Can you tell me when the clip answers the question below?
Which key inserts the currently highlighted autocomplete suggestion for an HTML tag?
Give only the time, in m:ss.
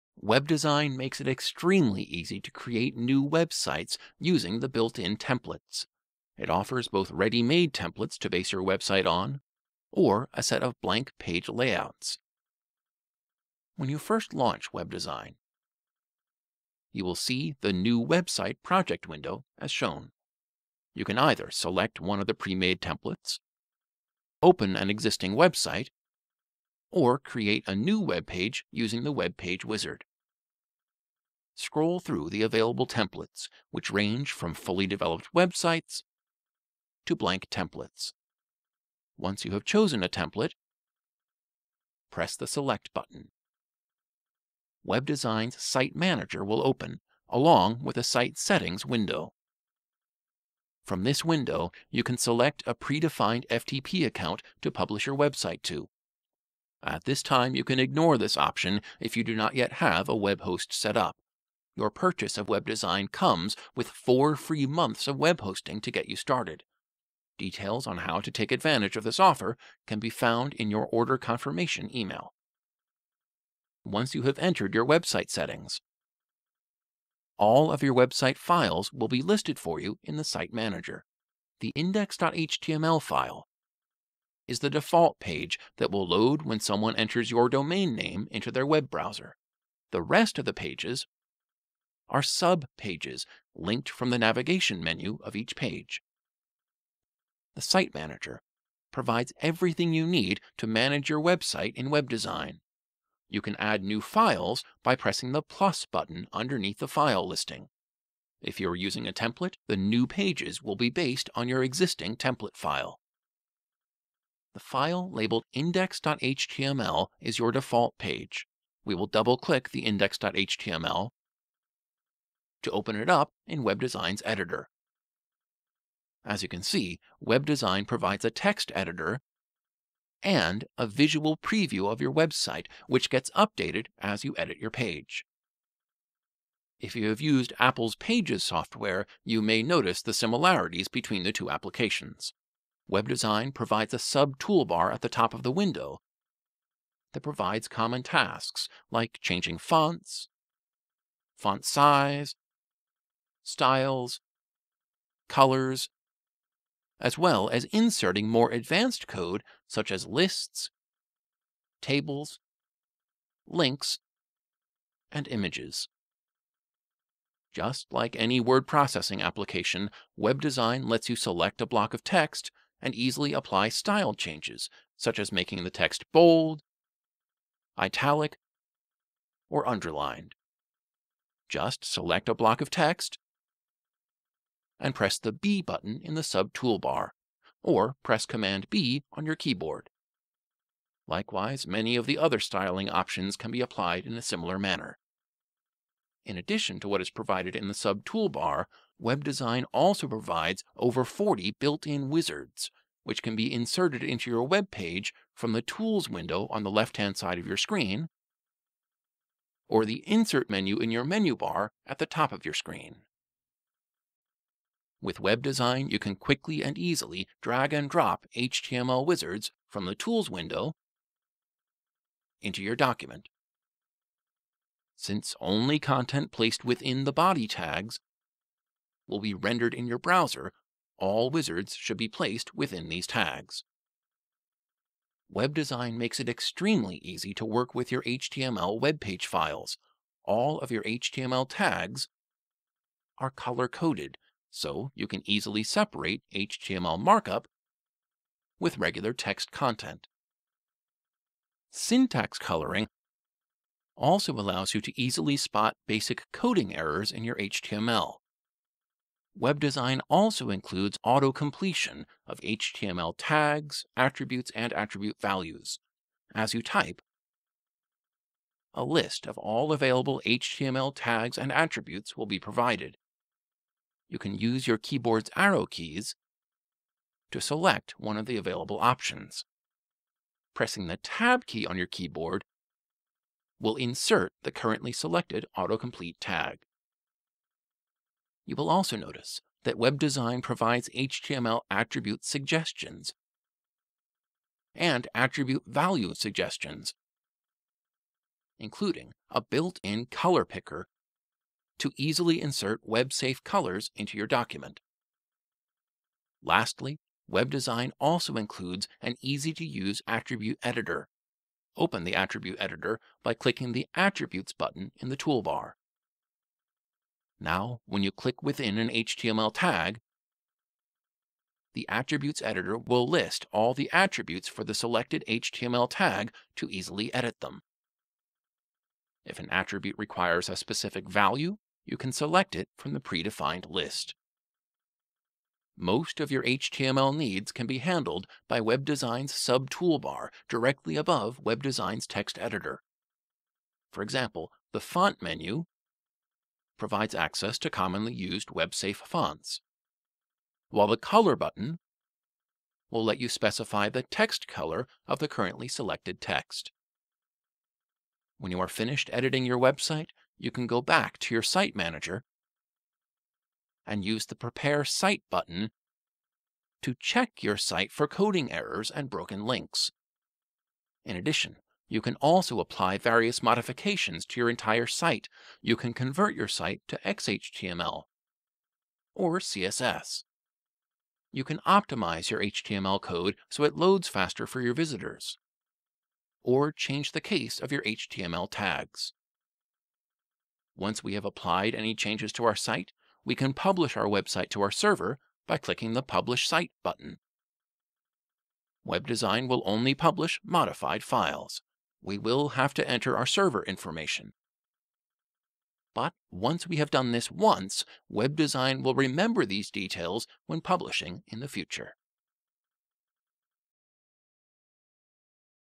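4:40.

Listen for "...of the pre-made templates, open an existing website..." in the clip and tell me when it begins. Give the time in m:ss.
0:22.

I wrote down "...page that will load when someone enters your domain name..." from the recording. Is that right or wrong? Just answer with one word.
right.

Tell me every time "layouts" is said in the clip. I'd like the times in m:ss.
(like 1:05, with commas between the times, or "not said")
0:11.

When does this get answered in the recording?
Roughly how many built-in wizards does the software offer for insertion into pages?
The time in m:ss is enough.
3:20.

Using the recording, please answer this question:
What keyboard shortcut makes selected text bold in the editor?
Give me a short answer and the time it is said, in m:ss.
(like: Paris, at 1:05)
Command B, at 3:08.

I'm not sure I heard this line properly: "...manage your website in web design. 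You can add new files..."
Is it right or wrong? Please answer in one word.
right.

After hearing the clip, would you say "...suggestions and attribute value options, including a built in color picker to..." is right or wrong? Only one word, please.
wrong.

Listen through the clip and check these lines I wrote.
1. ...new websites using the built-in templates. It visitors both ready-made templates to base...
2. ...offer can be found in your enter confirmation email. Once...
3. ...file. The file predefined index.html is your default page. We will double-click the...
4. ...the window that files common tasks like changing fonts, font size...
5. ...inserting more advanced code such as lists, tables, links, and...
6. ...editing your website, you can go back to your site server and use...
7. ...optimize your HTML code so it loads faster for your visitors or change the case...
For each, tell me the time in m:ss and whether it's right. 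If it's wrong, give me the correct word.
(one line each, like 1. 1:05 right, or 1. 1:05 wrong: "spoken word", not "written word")
1. 0:02 wrong: "offers", not "visitors"
2. 1:09 wrong: "order", not "enter"
3. 1:52 wrong: "labeled", not "predefined"
4. 2:25 wrong: "provides", not "files"
5. 2:37 right
6. 5:59 wrong: "manager", not "server"
7. 6:21 right.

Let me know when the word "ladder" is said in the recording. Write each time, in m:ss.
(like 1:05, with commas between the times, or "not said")
not said.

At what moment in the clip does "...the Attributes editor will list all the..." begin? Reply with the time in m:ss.
5:21.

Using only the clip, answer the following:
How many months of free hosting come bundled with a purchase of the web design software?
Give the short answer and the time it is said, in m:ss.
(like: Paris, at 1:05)
4, at 1:03.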